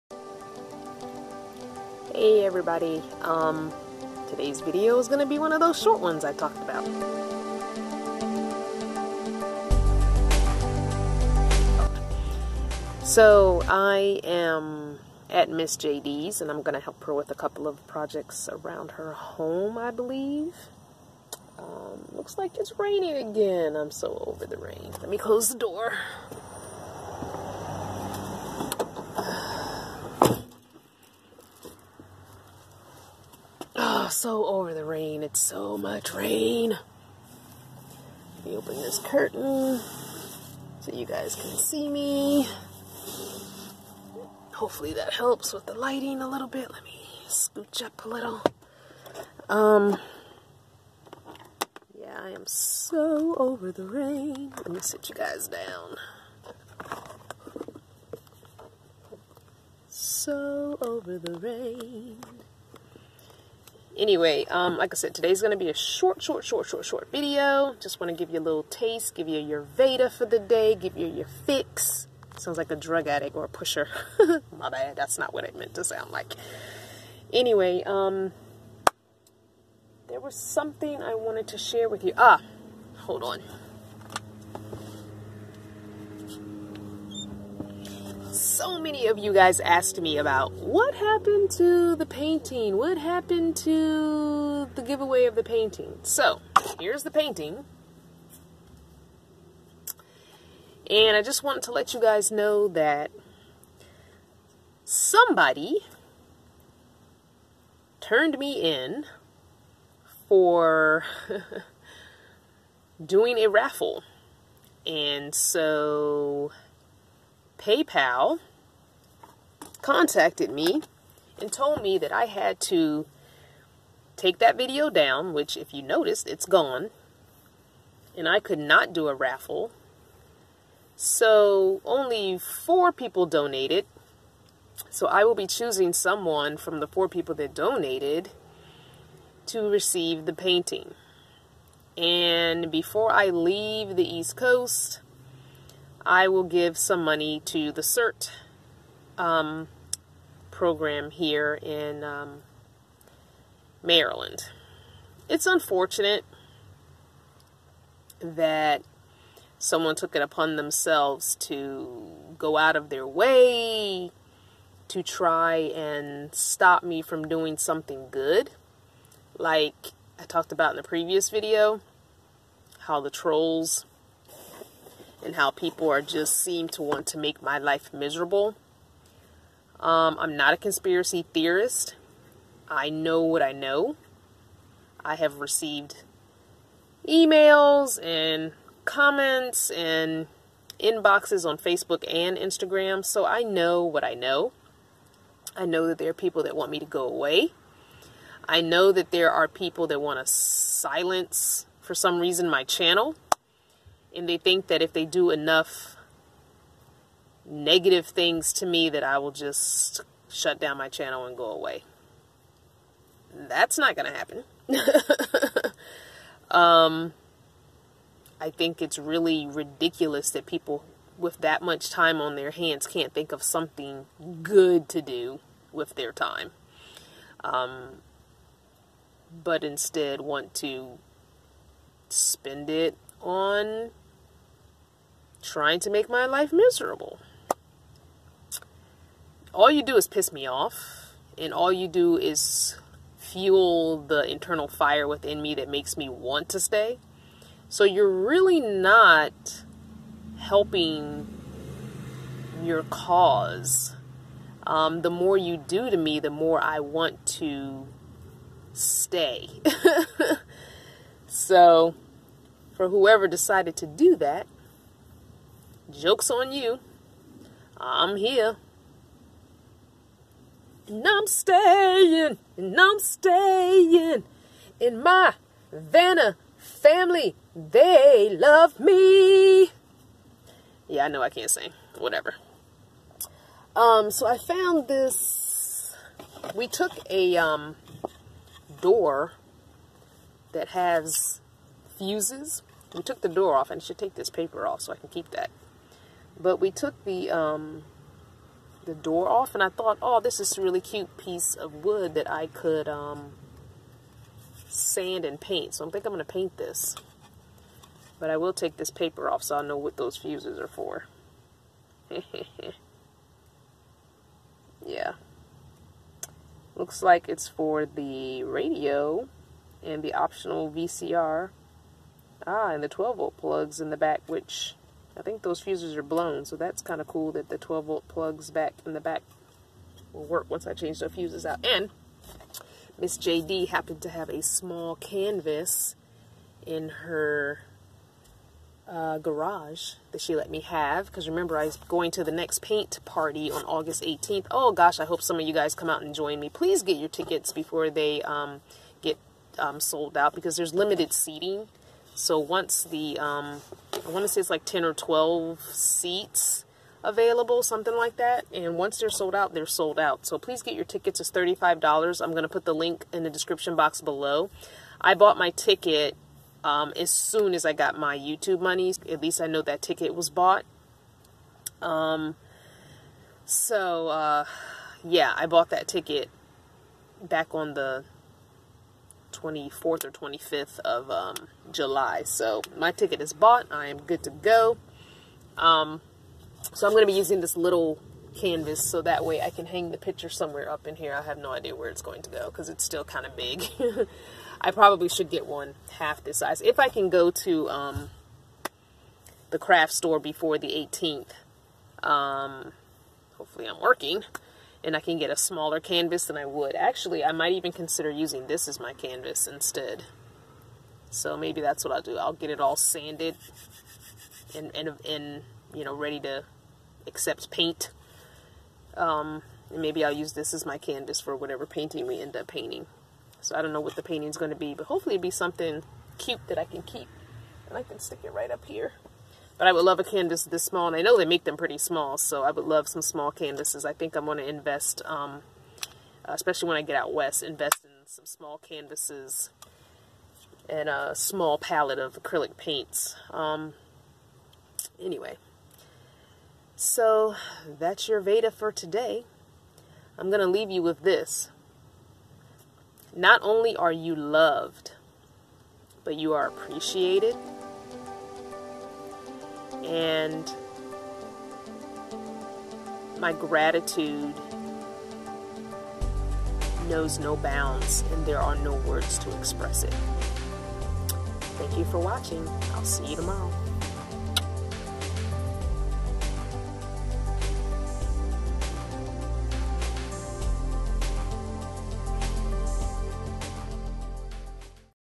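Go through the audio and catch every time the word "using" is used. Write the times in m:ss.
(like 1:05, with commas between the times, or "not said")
6:27, 6:48.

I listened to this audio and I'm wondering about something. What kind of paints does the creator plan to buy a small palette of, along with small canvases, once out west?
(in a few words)
acrylic.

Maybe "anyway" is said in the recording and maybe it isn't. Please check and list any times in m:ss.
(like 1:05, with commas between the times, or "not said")
1:03, 1:17, 7:24.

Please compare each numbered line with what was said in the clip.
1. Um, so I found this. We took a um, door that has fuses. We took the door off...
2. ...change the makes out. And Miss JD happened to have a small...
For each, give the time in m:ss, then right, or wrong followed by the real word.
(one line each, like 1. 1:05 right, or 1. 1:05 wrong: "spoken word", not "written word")
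1. 4:43 right
2. 5:30 wrong: "fuses", not "makes".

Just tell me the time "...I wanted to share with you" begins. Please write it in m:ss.
1:21.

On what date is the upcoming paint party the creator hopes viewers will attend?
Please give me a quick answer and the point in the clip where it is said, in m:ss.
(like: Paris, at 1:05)
August 18th, at 5:43.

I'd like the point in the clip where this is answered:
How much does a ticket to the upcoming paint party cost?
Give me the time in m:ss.
6:01.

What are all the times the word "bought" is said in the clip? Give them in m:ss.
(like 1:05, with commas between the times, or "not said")
6:05, 6:10, 6:15, 6:23.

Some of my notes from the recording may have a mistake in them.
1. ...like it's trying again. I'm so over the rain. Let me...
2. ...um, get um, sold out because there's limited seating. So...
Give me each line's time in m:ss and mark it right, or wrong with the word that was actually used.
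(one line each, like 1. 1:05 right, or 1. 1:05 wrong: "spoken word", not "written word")
1. 0:22 wrong: "raining", not "trying"
2. 5:48 right.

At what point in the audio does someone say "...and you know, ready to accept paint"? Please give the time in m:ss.
6:55.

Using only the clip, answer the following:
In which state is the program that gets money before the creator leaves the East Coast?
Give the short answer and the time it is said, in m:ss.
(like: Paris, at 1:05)
Maryland, at 2:33.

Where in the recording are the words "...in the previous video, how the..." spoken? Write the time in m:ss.
2:50.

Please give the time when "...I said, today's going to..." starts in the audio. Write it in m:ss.
1:04.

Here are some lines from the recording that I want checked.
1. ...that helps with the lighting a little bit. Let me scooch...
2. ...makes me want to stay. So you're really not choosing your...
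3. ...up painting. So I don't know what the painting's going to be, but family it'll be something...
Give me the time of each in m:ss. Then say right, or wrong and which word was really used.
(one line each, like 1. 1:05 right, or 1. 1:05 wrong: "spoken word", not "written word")
1. 0:44 right
2. 4:05 wrong: "helping", not "choosing"
3. 7:02 wrong: "hopefully", not "family".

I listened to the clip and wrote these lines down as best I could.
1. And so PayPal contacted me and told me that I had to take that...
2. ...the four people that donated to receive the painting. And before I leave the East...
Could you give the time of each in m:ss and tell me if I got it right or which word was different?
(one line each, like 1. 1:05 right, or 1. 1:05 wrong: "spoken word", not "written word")
1. 1:54 right
2. 2:16 right.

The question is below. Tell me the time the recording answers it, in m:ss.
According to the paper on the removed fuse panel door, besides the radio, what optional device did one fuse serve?
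5:20.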